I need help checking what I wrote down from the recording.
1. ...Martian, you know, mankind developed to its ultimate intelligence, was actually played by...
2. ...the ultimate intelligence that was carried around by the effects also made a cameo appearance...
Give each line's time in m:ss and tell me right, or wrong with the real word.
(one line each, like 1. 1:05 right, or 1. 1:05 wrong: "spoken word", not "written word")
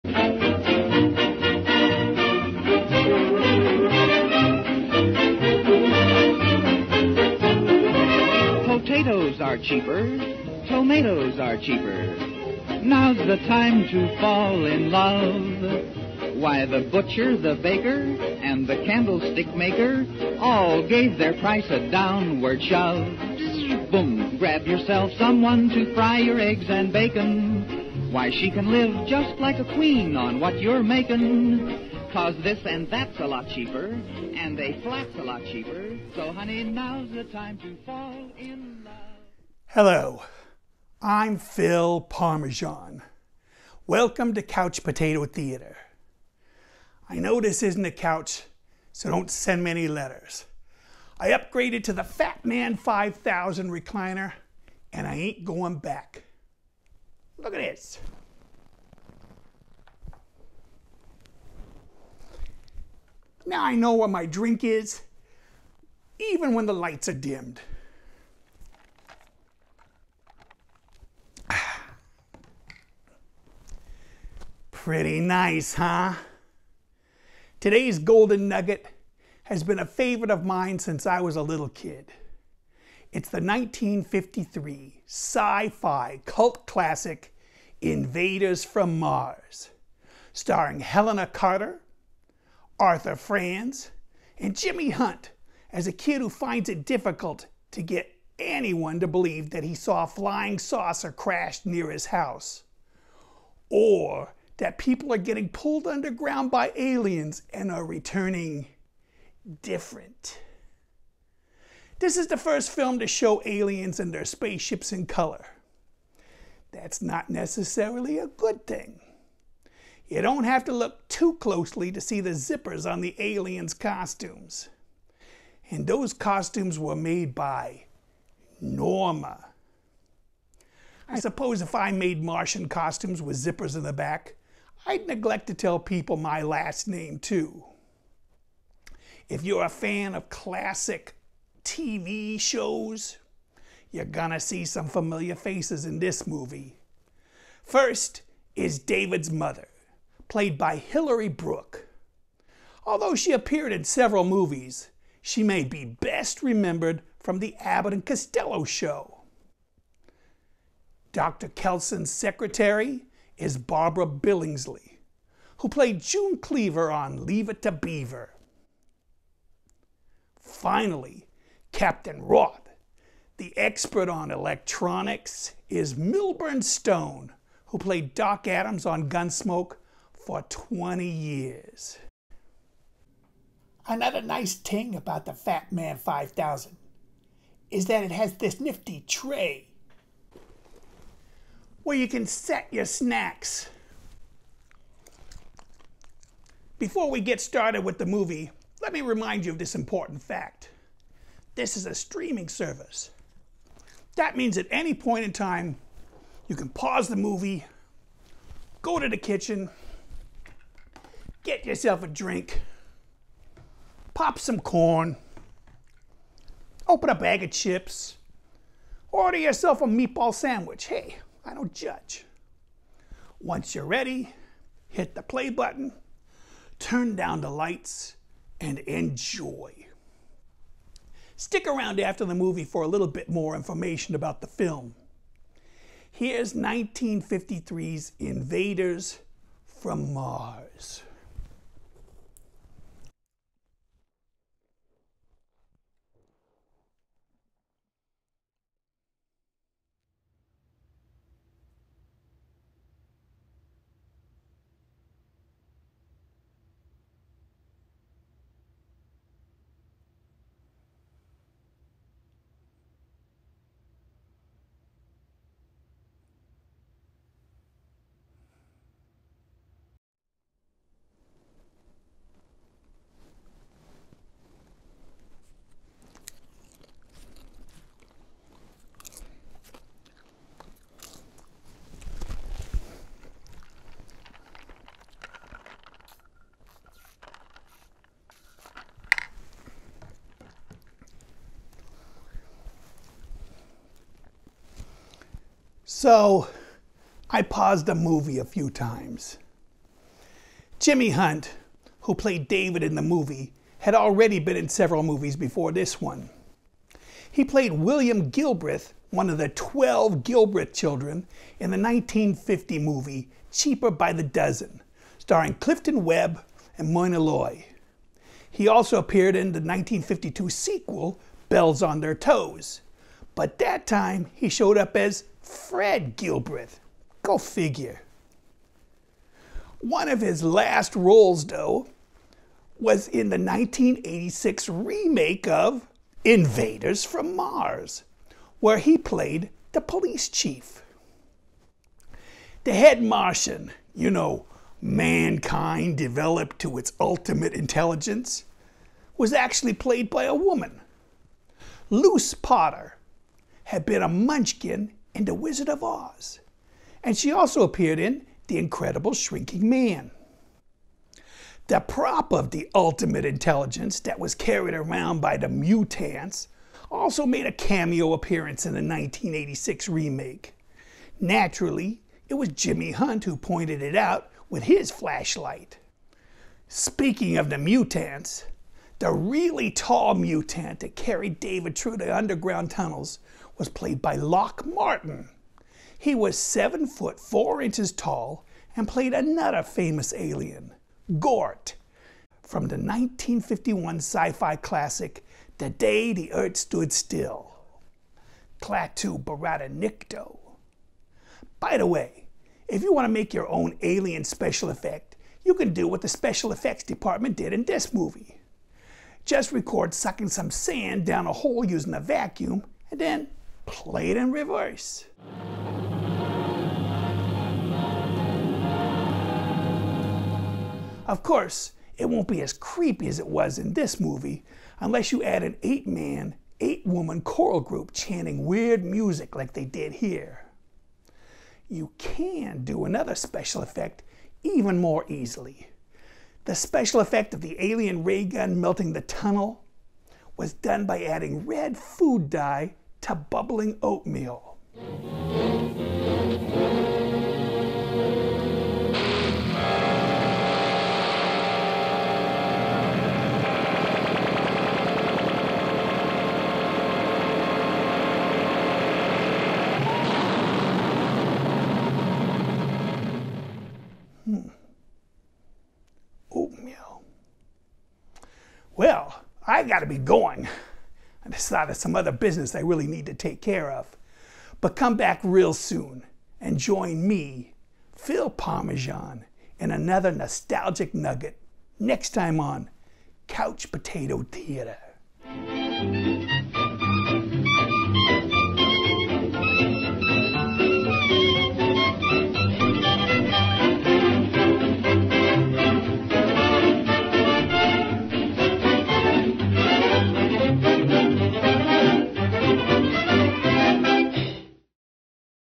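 1. 5:43 right
2. 6:02 wrong: "mutants", not "effects".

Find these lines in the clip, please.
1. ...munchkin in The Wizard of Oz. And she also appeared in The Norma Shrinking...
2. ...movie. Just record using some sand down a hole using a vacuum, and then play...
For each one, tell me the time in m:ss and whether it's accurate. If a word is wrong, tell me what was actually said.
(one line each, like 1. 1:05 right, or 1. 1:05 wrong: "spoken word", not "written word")
1. 5:54 wrong: "Incredible", not "Norma"
2. 6:47 wrong: "sucking", not "using".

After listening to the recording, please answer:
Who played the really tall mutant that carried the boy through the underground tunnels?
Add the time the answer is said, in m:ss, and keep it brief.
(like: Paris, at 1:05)
Lock Martin, at 6:24.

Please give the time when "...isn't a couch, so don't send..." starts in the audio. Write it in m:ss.
0:47.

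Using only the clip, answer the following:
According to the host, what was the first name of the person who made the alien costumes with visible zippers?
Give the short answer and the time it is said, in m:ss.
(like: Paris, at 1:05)
Norma, at 2:08.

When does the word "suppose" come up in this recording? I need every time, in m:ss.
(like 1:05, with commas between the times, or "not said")
2:11.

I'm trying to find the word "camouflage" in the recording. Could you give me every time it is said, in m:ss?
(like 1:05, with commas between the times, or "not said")
not said.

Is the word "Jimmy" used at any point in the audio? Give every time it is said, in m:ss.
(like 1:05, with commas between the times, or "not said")
1:34, 5:00, 6:12.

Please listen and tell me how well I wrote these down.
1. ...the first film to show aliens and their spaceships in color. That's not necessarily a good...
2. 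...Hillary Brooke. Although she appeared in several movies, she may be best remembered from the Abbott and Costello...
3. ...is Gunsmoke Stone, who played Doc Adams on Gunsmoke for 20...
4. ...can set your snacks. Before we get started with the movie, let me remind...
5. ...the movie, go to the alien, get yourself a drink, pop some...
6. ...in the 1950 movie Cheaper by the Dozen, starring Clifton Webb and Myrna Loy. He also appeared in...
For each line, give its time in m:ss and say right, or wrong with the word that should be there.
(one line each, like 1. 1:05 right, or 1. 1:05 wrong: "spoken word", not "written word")
1. 1:52 right
2. 2:30 right
3. 2:55 wrong: "Milburn", not "Gunsmoke"
4. 3:12 right
5. 3:27 wrong: "kitchen", not "alien"
6. 5:11 right.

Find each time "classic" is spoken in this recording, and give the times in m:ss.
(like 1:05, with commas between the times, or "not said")
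1:26, 2:20, 6:34.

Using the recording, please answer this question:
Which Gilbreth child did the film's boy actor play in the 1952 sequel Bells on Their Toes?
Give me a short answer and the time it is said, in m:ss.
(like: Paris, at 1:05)
Fred Gilbreth, at 5:25.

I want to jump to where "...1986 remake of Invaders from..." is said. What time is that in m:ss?
5:33.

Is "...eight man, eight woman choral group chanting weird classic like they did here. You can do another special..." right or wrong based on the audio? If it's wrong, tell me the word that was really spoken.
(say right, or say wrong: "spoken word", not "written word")
wrong: "music", not "classic".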